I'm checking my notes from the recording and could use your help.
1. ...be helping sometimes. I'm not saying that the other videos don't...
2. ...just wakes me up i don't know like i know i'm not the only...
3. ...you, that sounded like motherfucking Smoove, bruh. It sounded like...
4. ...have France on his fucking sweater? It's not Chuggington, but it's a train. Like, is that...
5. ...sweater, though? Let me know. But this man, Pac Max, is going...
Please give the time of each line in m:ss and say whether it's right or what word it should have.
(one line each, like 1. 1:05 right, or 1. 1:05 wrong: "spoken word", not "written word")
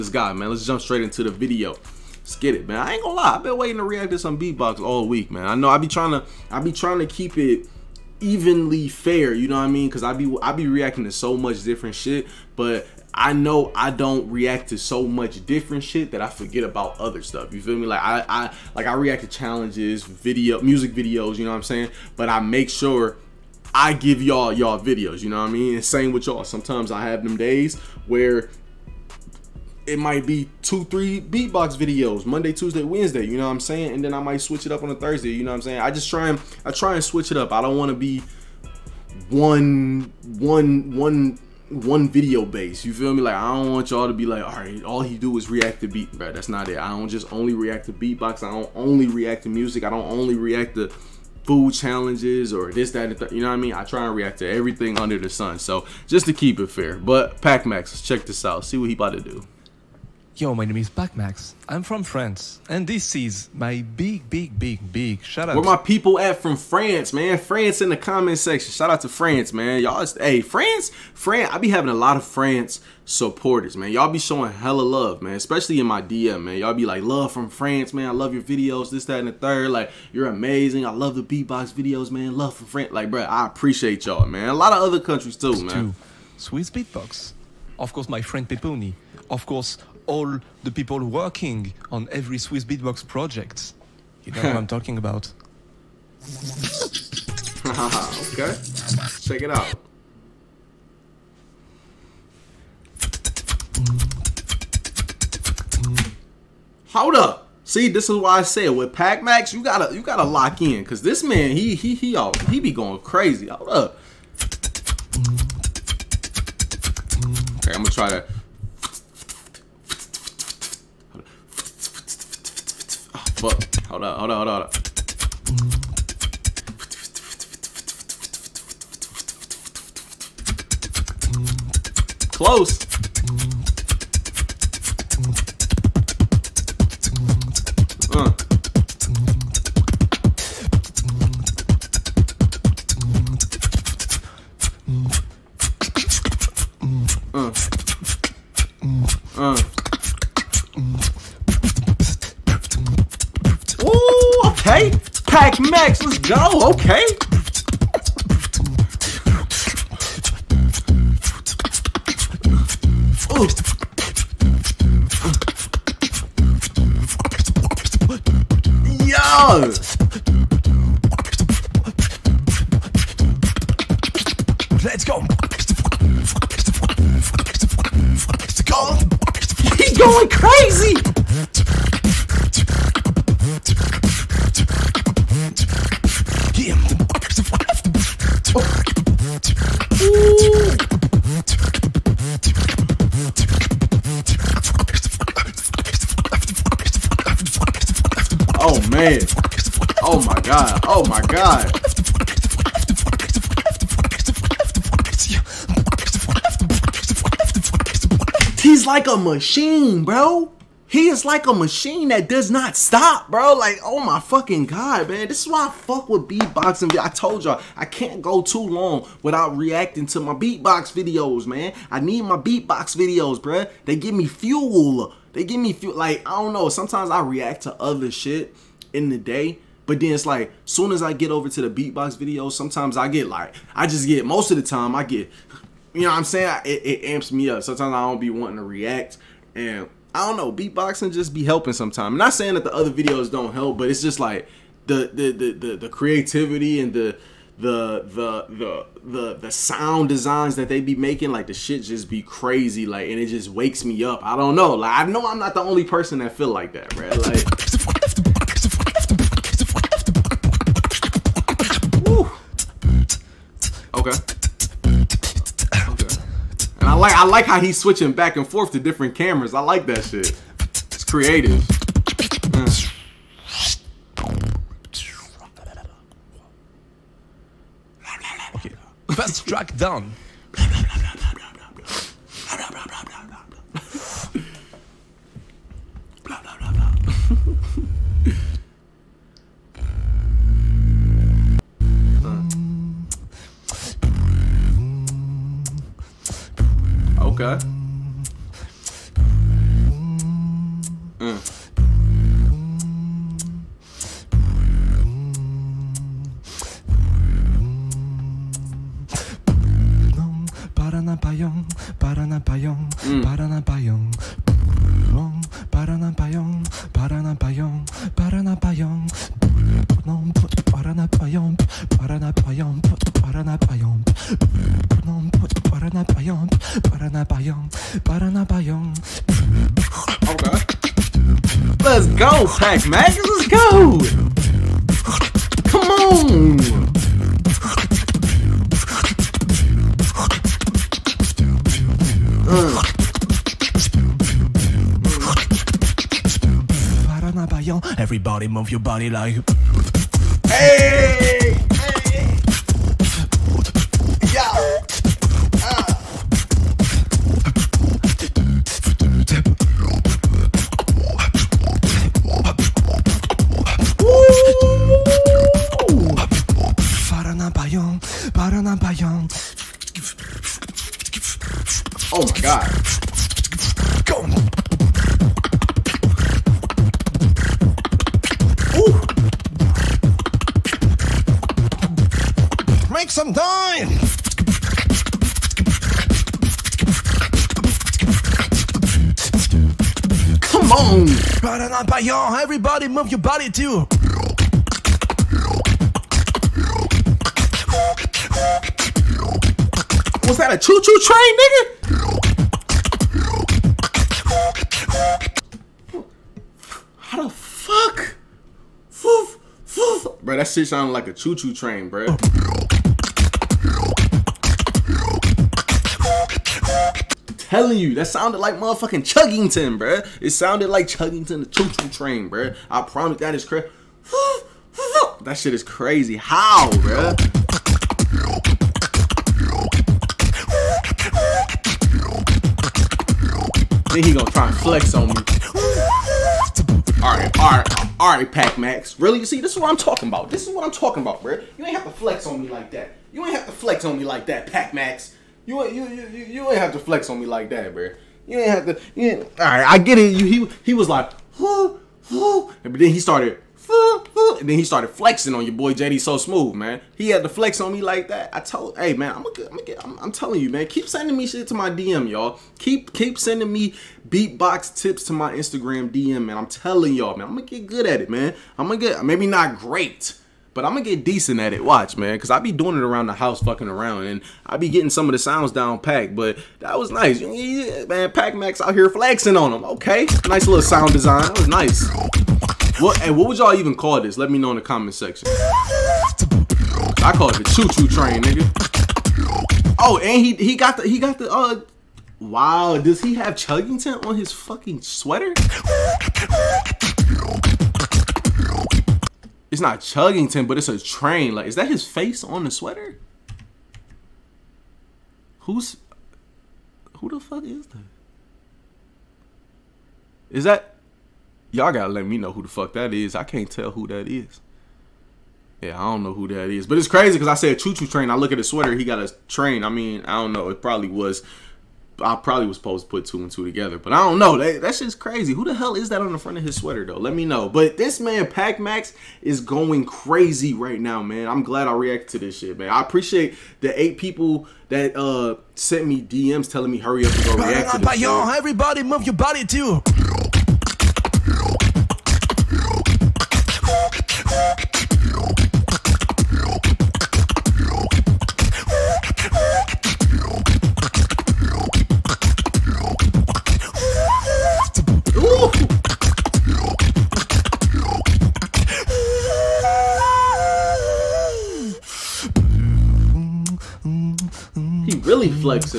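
1. 4:01 right
2. 4:13 right
3. 6:57 wrong: "Chuggington", not "Smoove"
4. 8:13 wrong: "Chuggington", not "France"
5. 8:46 right.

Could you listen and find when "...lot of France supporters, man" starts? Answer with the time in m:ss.
1:11.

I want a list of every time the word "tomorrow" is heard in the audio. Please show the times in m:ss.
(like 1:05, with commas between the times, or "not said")
not said.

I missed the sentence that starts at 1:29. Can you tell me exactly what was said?
Of course, all the people working on every Swiss Beatbox project.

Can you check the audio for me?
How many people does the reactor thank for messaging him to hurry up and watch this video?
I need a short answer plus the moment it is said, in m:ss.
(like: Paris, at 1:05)
8, at 8:53.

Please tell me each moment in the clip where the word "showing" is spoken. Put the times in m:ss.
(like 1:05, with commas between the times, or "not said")
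1:14.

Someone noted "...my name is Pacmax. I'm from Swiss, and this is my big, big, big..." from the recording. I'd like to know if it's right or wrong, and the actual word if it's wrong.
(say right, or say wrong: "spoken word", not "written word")
wrong: "France", not "Swiss".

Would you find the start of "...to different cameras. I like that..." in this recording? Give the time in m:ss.
4:28.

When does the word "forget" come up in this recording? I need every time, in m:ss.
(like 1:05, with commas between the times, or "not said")
0:16.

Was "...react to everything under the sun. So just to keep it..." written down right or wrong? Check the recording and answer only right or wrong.
right.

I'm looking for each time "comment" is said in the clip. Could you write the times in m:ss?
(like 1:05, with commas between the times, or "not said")
1:07, 8:04.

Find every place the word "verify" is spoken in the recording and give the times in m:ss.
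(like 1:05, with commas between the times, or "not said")
not said.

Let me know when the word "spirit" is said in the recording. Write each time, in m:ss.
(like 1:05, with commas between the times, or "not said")
not said.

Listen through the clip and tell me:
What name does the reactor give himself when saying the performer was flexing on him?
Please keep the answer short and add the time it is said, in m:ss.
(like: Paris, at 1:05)
JD so Smoove, at 7:35.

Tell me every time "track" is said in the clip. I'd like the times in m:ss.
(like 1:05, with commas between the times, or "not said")
4:39.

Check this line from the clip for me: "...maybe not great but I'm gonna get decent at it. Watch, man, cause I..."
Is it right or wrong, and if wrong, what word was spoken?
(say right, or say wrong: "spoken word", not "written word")
right.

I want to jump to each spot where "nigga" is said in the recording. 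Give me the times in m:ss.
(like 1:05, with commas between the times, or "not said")
6:41, 8:08.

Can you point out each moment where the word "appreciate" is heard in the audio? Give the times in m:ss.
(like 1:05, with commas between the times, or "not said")
1:23, 8:52.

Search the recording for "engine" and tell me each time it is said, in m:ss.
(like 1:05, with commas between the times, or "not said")
not said.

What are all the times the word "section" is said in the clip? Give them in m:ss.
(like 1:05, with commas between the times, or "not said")
1:08, 8:04.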